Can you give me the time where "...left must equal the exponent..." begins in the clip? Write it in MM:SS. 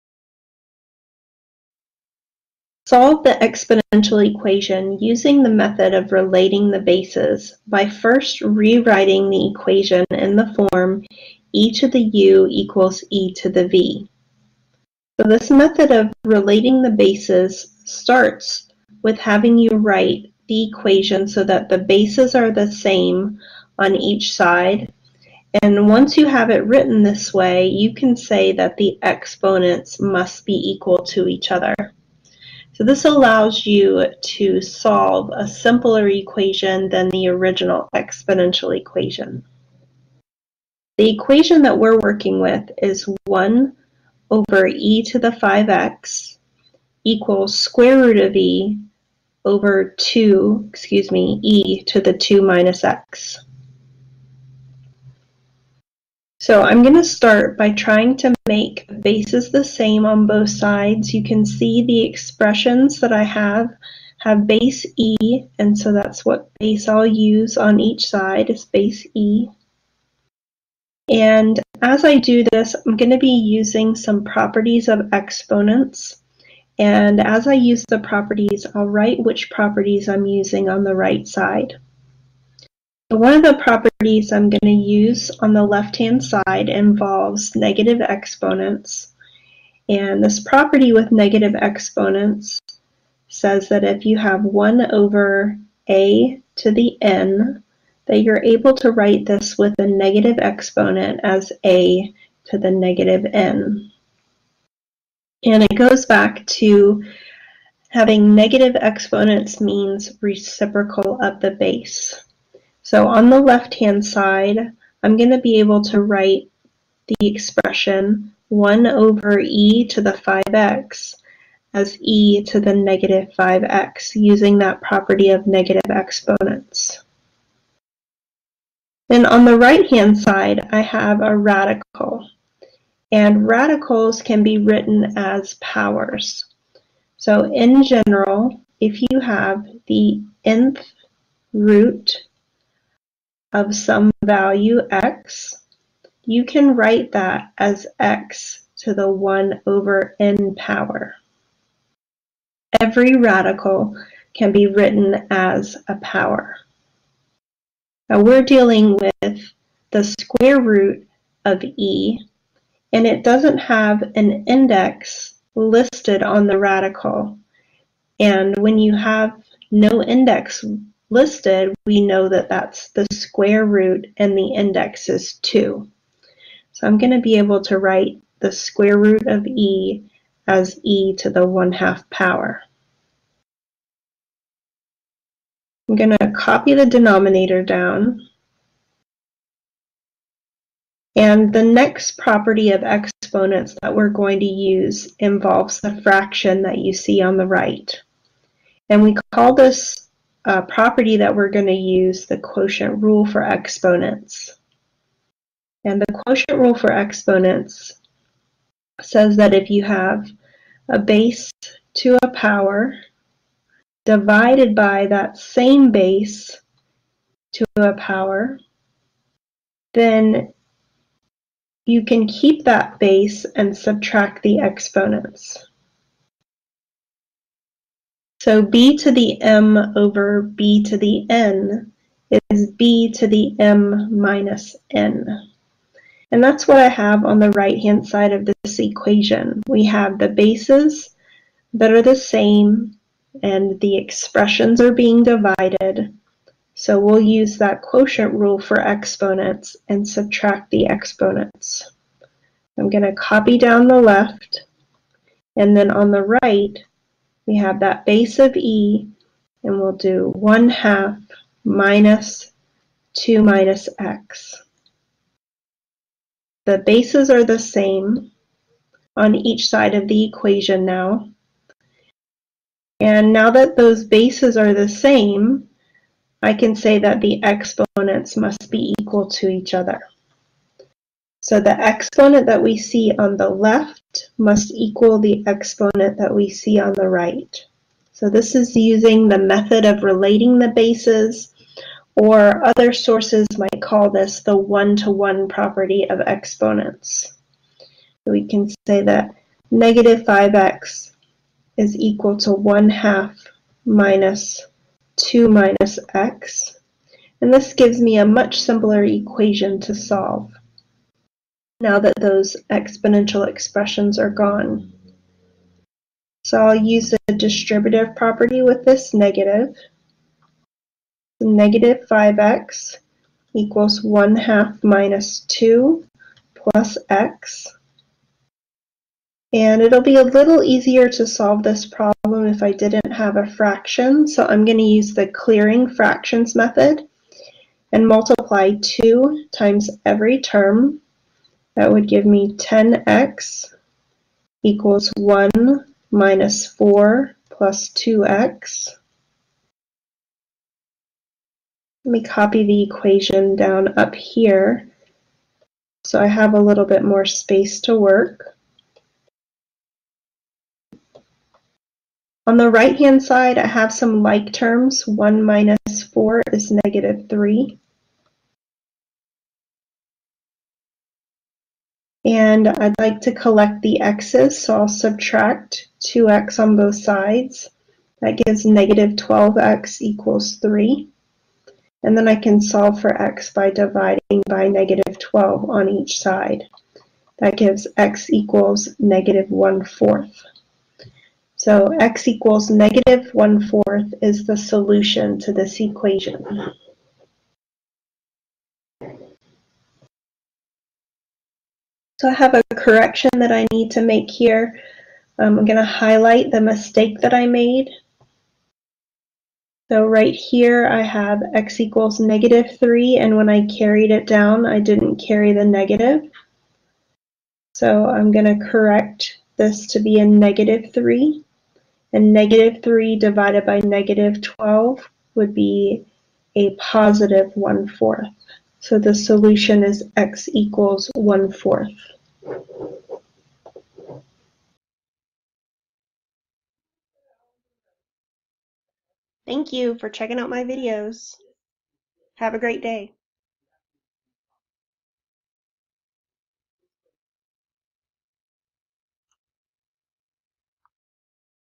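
04:43.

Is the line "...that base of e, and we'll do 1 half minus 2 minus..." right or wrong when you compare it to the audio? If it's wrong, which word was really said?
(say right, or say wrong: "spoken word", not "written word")
right.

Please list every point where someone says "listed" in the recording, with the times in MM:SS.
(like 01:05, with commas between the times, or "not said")
02:45, 02:51.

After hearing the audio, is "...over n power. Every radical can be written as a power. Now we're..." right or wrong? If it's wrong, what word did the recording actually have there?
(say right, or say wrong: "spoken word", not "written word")
right.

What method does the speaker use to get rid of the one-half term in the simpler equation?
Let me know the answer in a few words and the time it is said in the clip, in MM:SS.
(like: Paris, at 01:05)
clearing fractions method, at 05:35.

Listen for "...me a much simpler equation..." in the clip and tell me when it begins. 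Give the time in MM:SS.
05:07.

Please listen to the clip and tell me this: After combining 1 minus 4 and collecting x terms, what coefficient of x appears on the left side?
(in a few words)
-12.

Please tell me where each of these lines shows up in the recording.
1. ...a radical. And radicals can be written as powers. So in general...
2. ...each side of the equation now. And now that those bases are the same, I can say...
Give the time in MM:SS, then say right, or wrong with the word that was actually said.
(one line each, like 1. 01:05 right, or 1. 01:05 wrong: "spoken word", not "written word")
1. 02:11 right
2. 04:29 right.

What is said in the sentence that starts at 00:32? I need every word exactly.
So this allows you to solve a simpler equation than the original exponential equation.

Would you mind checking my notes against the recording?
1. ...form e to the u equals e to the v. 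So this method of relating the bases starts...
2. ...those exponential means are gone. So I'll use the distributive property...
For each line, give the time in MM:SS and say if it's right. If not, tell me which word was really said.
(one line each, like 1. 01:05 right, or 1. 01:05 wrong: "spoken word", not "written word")
1. 00:10 right
2. 05:12 wrong: "expressions", not "means".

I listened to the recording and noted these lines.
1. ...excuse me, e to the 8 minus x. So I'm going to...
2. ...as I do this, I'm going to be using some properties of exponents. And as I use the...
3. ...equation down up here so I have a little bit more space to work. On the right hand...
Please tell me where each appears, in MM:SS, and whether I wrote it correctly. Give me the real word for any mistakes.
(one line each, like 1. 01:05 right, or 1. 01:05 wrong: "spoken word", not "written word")
1. 00:50 wrong: "2", not "8"
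2. 01:11 right
3. 05:52 right.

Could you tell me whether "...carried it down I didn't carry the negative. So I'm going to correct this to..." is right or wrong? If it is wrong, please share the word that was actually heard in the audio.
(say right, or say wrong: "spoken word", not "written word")
right.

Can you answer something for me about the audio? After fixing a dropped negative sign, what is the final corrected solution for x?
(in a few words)
1/4.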